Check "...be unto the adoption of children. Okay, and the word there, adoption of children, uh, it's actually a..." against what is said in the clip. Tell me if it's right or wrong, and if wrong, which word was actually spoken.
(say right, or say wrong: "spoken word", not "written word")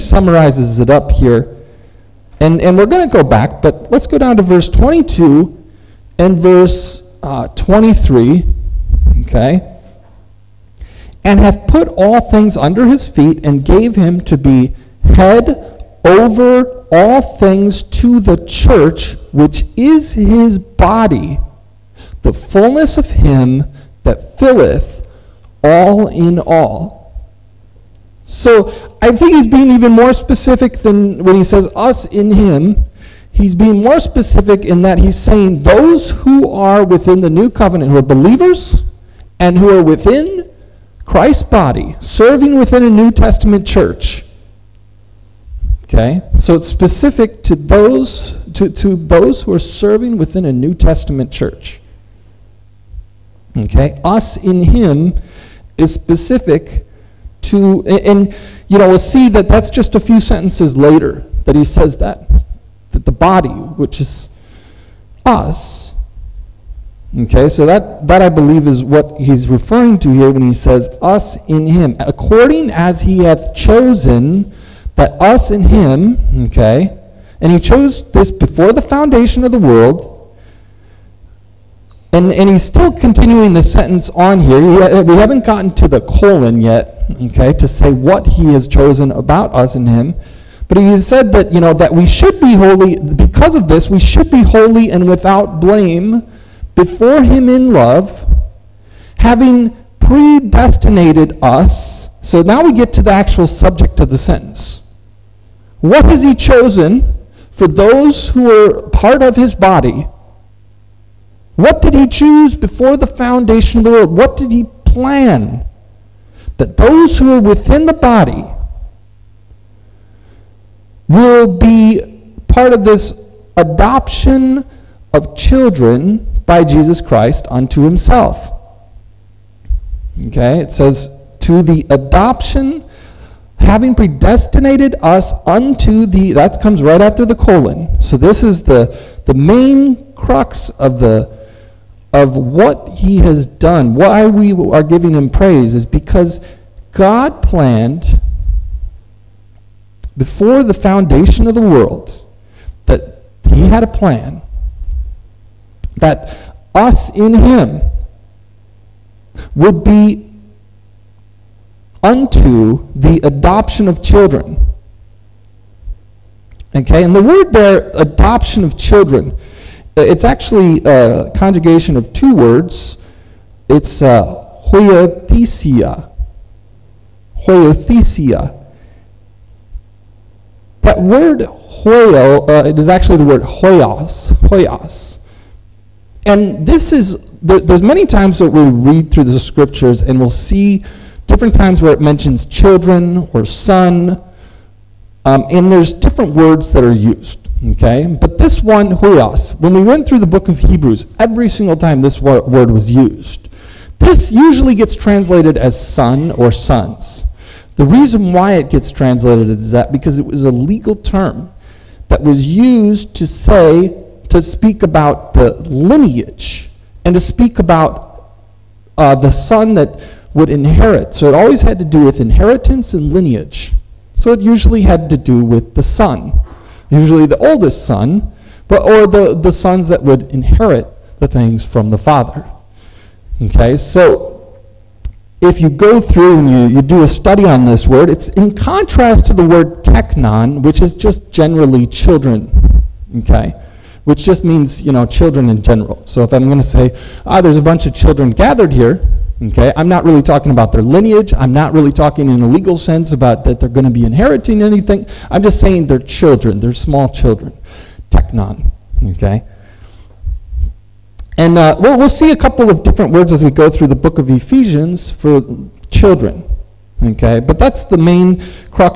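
right.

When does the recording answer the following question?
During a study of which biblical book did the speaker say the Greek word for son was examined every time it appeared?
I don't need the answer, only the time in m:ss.
3:20.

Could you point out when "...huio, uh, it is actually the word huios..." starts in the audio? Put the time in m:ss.
3:01.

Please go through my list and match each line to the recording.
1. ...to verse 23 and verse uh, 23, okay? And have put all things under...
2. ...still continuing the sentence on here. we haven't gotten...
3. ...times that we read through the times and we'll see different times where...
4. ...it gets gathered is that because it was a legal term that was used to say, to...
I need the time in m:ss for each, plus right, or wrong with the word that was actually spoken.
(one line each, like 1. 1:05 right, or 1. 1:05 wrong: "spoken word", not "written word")
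1. 0:04 wrong: "22", not "23"
2. 1:22 right
3. 3:08 wrong: "scriptures", not "times"
4. 3:28 wrong: "translated", not "gathered".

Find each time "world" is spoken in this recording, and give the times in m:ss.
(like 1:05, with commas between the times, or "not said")
1:19, 1:53, 2:31.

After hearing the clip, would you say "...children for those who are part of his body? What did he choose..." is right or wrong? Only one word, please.
wrong.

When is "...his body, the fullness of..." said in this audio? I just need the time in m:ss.
0:20.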